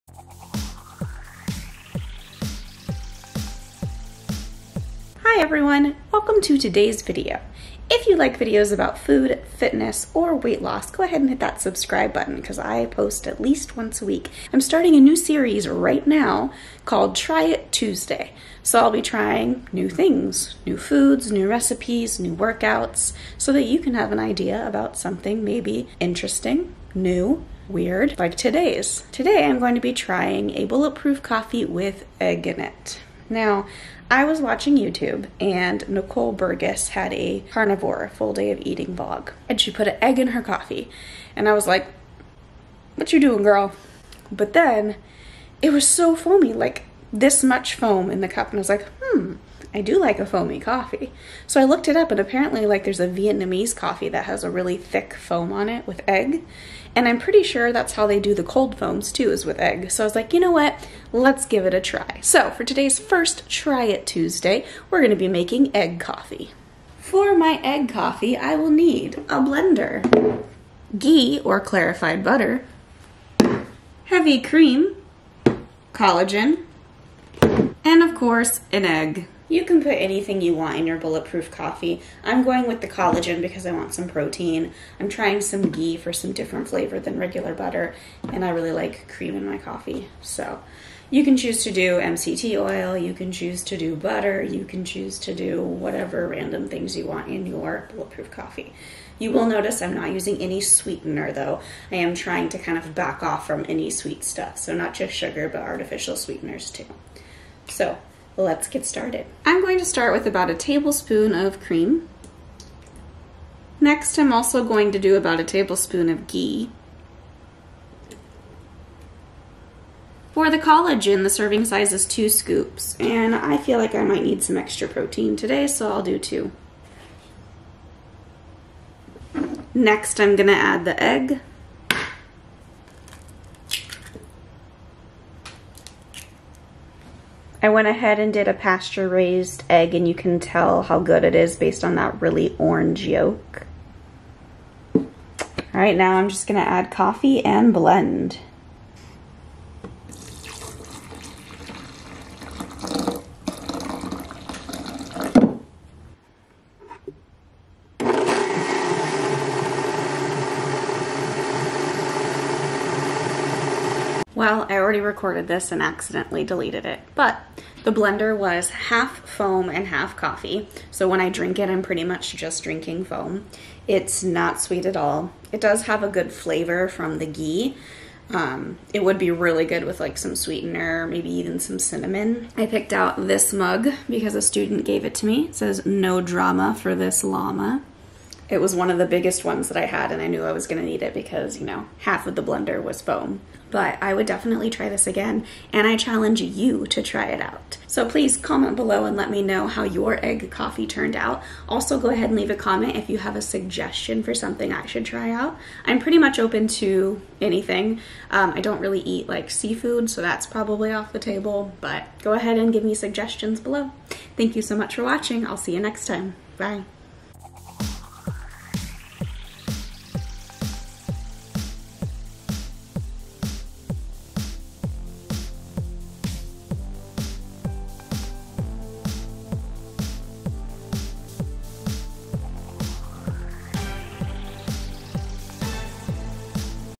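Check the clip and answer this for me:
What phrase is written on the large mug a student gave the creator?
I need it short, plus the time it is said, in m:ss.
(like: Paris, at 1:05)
No drama for this llama, at 3:05.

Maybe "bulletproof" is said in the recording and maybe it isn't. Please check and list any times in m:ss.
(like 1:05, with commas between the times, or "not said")
0:30, 1:20, 1:37.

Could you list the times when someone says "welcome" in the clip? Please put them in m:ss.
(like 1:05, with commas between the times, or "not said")
0:06.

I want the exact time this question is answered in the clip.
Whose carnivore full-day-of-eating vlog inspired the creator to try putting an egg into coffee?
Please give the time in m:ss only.
0:35.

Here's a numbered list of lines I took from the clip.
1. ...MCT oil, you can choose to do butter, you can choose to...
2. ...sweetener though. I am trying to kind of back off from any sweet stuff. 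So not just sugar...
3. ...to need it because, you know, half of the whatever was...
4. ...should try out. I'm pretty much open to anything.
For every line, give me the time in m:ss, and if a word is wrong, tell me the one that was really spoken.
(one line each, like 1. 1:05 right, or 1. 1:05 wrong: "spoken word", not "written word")
1. 1:31 right
2. 1:40 right
3. 3:10 wrong: "blender", not "whatever"
4. 3:24 right.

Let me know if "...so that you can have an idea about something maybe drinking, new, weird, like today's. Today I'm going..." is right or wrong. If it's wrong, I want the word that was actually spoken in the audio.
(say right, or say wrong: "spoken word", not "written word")
wrong: "interesting", not "drinking".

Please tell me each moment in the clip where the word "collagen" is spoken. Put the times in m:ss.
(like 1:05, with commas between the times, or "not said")
1:15, 1:22, 2:00.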